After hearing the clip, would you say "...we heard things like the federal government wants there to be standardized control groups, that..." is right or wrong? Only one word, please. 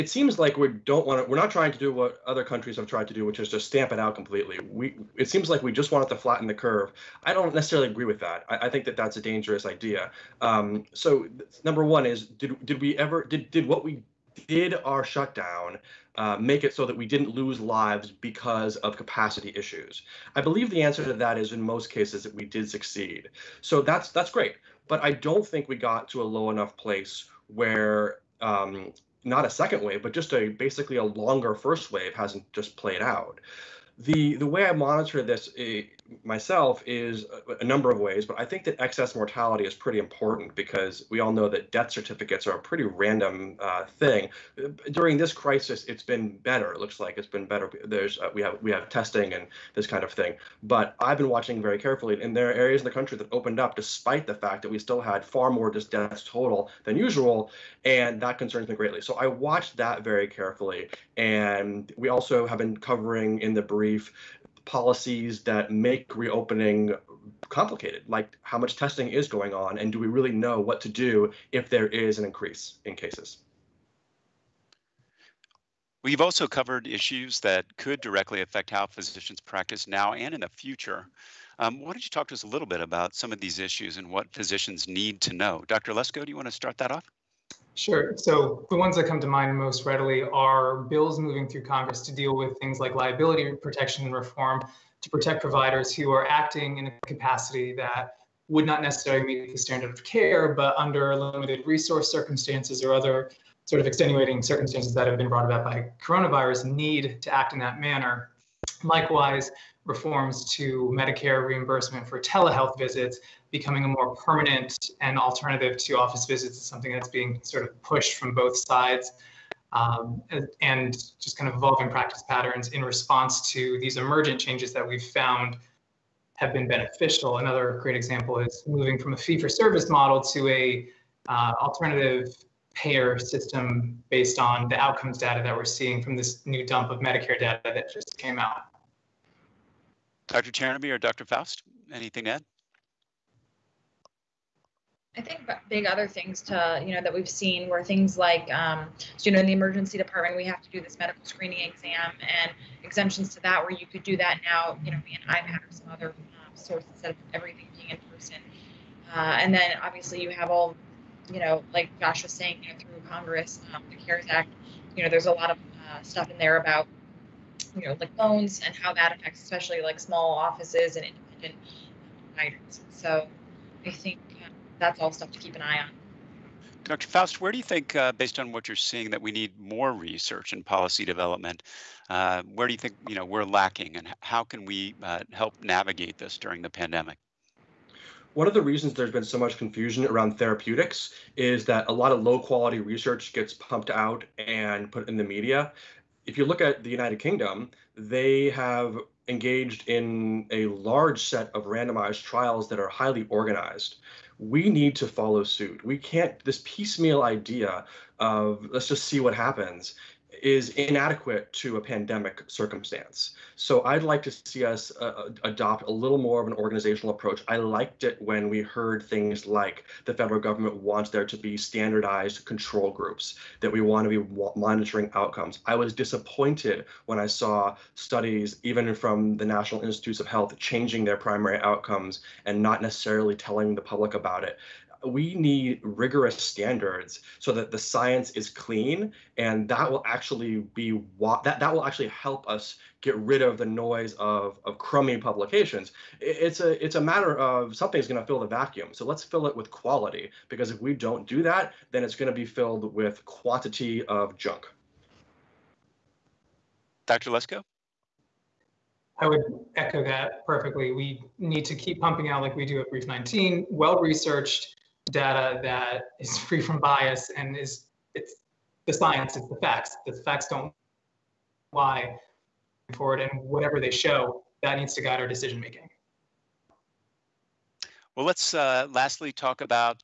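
right.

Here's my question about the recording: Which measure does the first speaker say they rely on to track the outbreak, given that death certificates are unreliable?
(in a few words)
Excess mortality.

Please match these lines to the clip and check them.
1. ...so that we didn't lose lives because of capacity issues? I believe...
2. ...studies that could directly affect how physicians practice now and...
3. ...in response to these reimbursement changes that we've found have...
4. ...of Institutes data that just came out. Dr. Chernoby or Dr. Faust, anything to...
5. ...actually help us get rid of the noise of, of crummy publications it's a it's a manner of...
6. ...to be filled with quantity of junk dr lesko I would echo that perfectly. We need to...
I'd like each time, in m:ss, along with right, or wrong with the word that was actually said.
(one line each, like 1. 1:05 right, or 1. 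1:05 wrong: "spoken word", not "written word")
1. 0:16 right
2. 1:16 wrong: "issues", not "studies"
3. 2:02 wrong: "emergent", not "reimbursement"
4. 2:16 wrong: "Medicare", not "Institutes"
5. 4:01 wrong: "matter", not "manner"
6. 4:12 right.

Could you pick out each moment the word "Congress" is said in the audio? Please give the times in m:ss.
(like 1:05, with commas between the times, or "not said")
1:31, 2:43.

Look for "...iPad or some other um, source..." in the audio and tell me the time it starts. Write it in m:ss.
2:35.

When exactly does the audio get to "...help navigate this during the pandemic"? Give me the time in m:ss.
3:05.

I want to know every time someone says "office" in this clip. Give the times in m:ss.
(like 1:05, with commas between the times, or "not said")
1:55, 2:50.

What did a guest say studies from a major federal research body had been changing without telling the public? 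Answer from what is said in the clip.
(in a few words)
Primary outcomes.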